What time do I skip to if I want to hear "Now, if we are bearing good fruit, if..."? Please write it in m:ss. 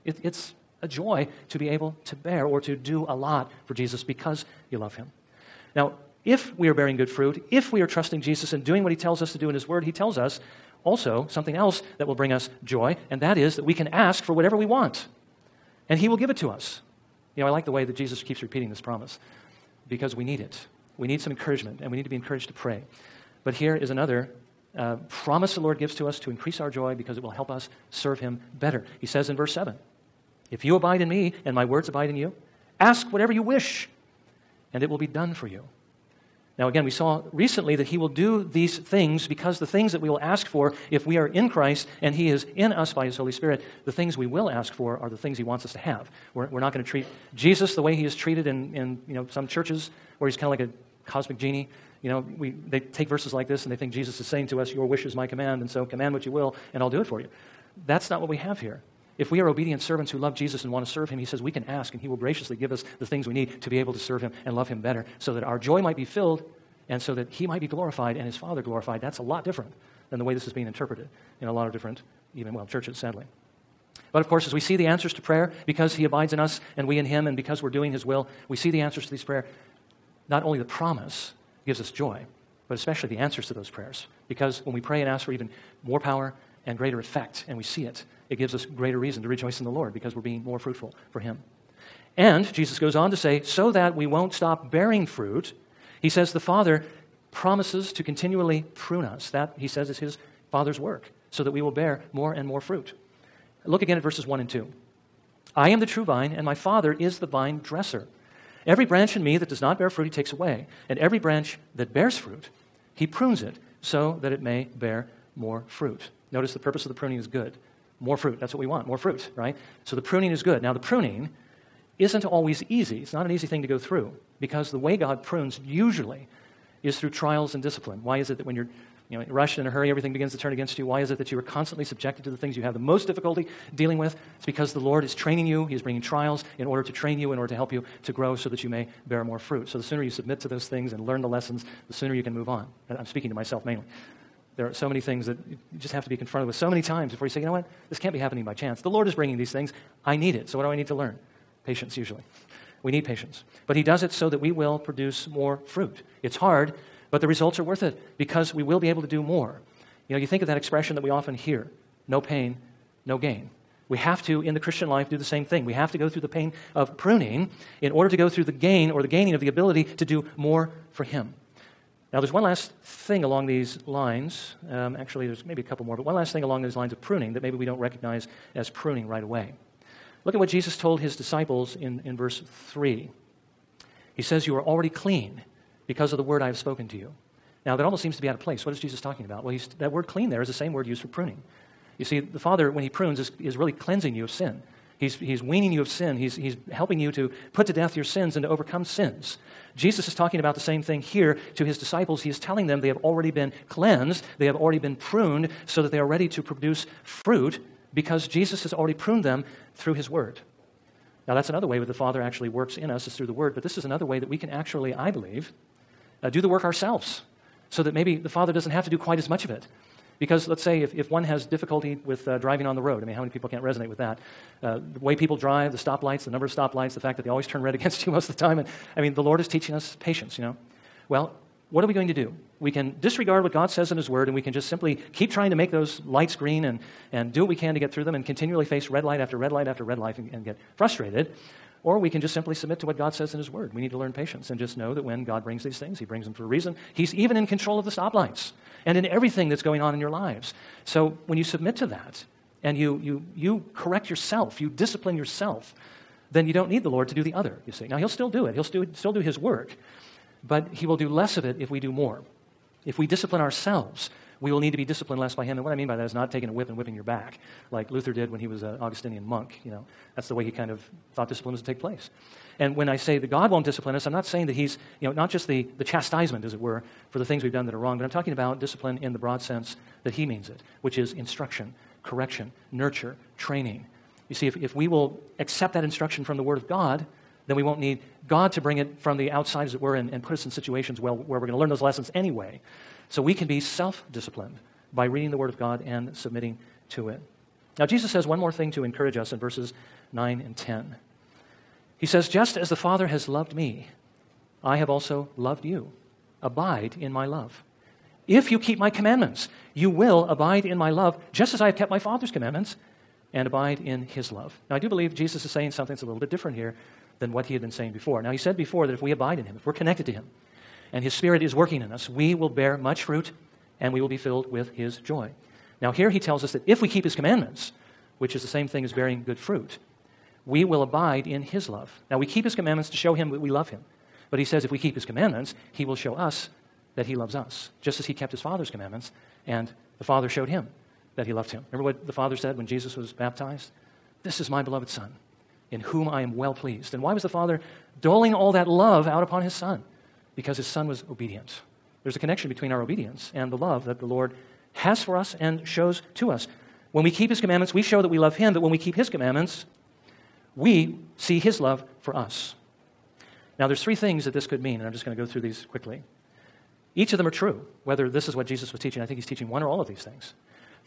0:05.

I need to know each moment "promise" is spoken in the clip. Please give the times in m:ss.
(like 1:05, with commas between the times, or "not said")
0:18, 0:25, 1:20, 1:37.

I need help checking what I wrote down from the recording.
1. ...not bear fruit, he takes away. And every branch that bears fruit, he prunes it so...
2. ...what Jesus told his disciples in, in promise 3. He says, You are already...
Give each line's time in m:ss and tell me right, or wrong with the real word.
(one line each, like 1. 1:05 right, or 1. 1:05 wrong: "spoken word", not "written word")
1. 1:49 right
2. 3:00 wrong: "verse", not "promise".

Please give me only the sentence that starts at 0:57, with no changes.
That's not what we have here.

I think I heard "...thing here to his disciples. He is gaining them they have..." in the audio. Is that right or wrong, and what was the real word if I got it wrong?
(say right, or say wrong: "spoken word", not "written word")
wrong: "telling", not "gaining".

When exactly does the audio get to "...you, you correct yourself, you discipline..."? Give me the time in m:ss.
4:13.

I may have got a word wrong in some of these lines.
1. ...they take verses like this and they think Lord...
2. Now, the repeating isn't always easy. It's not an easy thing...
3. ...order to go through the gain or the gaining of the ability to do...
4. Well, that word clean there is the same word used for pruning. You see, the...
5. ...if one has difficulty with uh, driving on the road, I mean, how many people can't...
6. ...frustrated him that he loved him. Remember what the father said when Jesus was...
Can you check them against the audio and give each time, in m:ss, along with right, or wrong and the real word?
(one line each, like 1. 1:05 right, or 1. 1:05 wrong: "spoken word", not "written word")
1. 0:52 wrong: "Jesus", not "Lord"
2. 2:00 wrong: "pruning", not "repeating"
3. 2:47 right
4. 3:09 right
5. 3:40 right
6. 5:40 wrong: "showed", not "frustrated".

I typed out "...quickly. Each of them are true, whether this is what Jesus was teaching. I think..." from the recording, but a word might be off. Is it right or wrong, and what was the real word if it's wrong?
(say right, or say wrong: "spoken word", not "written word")
right.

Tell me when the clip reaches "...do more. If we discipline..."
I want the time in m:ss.
4:21.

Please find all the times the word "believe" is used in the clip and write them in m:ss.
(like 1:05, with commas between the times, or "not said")
3:35, 5:14.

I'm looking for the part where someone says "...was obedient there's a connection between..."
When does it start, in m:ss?
5:50.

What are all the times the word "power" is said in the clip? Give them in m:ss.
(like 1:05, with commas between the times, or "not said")
1:25.